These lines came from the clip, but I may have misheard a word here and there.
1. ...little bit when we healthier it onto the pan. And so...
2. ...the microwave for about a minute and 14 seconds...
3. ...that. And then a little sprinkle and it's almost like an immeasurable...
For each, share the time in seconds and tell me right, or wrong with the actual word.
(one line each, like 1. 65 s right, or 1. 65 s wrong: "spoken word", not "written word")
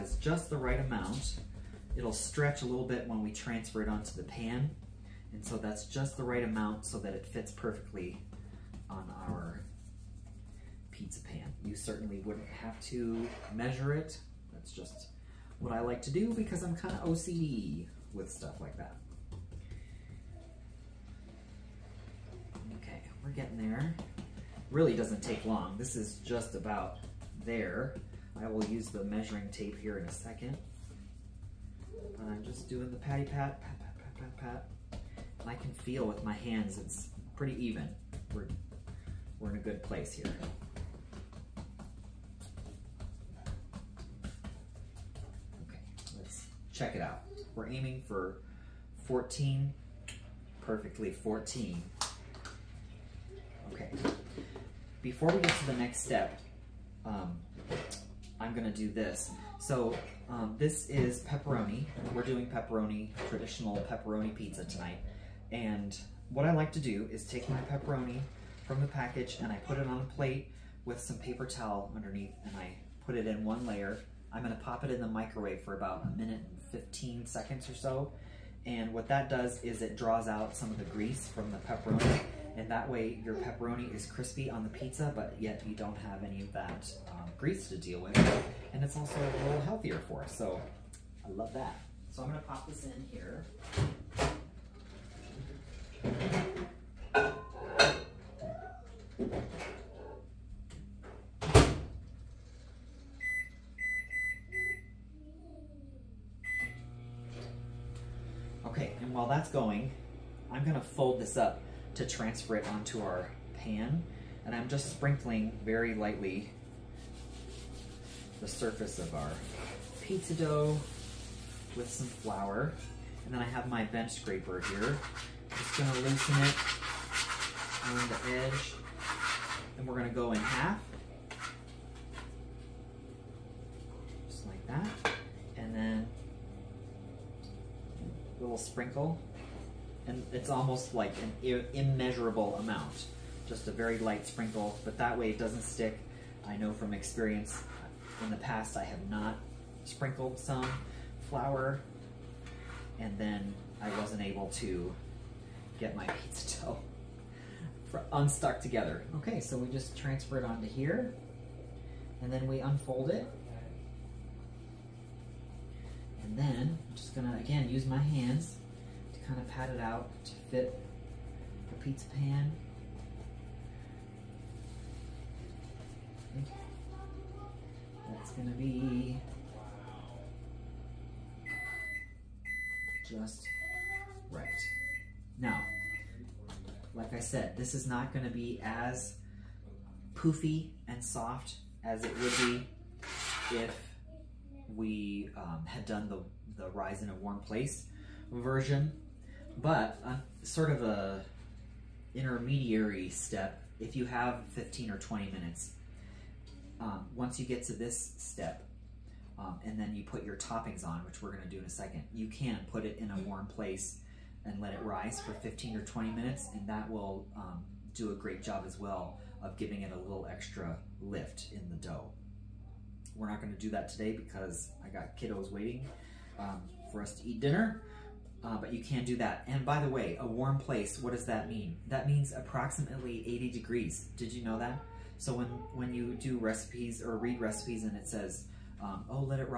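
1. 2 s wrong: "transfer", not "healthier"
2. 74 s wrong: "15", not "14"
3. 134 s right.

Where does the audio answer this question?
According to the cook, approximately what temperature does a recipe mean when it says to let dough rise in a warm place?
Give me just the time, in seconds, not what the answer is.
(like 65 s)
233 s.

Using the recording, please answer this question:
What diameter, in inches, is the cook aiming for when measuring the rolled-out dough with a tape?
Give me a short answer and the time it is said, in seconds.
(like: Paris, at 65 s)
14, at 50 s.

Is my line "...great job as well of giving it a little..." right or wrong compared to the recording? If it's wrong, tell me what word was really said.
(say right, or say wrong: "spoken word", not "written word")
right.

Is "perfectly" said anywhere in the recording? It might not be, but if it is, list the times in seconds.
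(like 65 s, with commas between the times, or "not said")
7 s, 50 s.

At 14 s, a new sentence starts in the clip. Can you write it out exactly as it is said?
That's just what I like to do because I'm kind of OCD with stuff like that.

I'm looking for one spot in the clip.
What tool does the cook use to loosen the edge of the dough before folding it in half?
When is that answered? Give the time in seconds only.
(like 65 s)
123 s.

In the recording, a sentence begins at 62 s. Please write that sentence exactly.
We're doing pepperoni, traditional pepperoni pizza tonight.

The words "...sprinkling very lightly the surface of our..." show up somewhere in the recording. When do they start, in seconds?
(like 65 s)
114 s.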